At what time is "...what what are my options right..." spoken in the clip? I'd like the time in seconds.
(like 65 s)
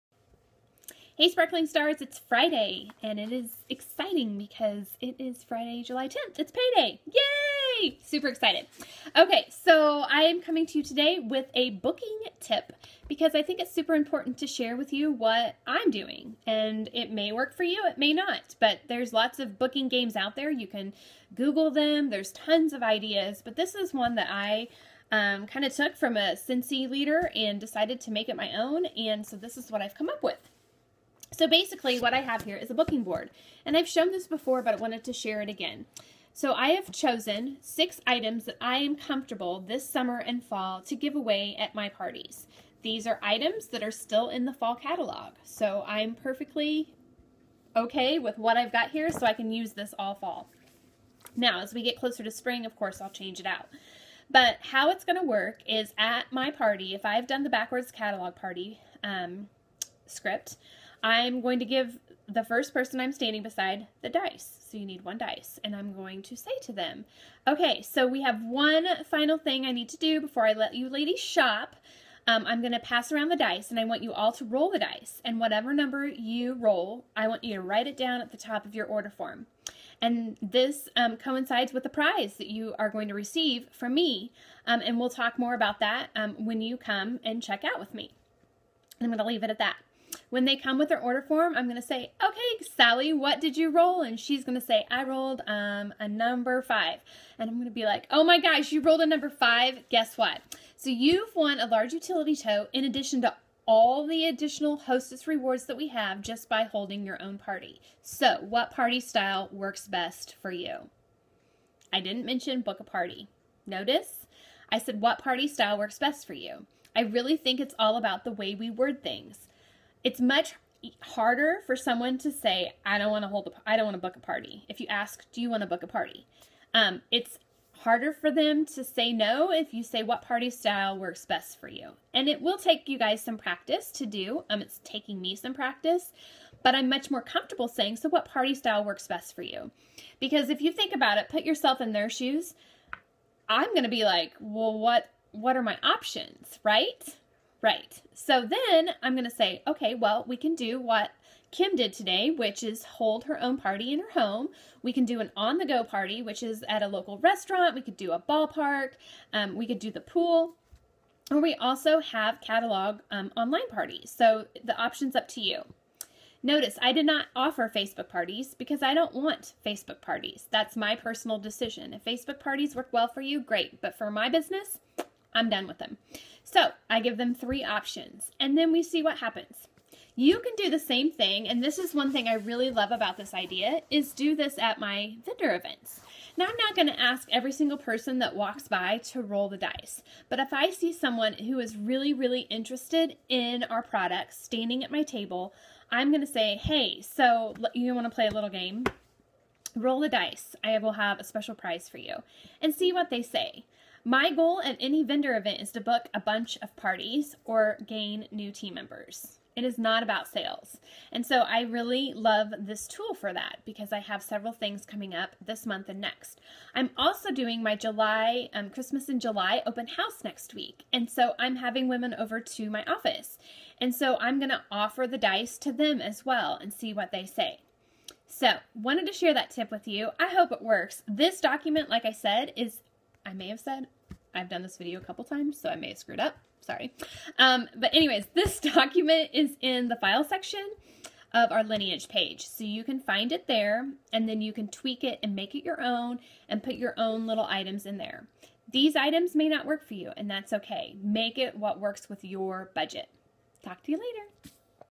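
144 s.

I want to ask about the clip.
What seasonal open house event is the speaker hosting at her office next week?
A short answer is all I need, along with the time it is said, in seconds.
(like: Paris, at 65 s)
Christmas in July, at 218 s.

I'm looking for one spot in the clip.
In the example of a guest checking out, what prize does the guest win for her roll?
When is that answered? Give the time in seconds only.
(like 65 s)
101 s.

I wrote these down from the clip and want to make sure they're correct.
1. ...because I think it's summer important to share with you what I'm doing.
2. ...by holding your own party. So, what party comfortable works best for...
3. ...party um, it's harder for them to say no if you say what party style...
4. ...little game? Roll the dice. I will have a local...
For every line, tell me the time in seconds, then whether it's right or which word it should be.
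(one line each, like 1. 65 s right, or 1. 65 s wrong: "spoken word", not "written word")
1. 13 s wrong: "super", not "summer"
2. 106 s wrong: "style", not "comfortable"
3. 125 s right
4. 198 s wrong: "special", not "local".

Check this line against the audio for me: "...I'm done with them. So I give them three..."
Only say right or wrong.
right.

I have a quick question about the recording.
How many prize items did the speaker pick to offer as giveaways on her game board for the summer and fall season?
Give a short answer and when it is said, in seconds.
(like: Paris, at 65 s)
6, at 37 s.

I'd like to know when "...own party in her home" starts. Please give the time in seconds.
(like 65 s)
153 s.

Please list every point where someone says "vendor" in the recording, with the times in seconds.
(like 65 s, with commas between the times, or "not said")
185 s, 205 s.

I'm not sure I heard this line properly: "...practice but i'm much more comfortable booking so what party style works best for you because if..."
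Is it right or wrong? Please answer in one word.
wrong.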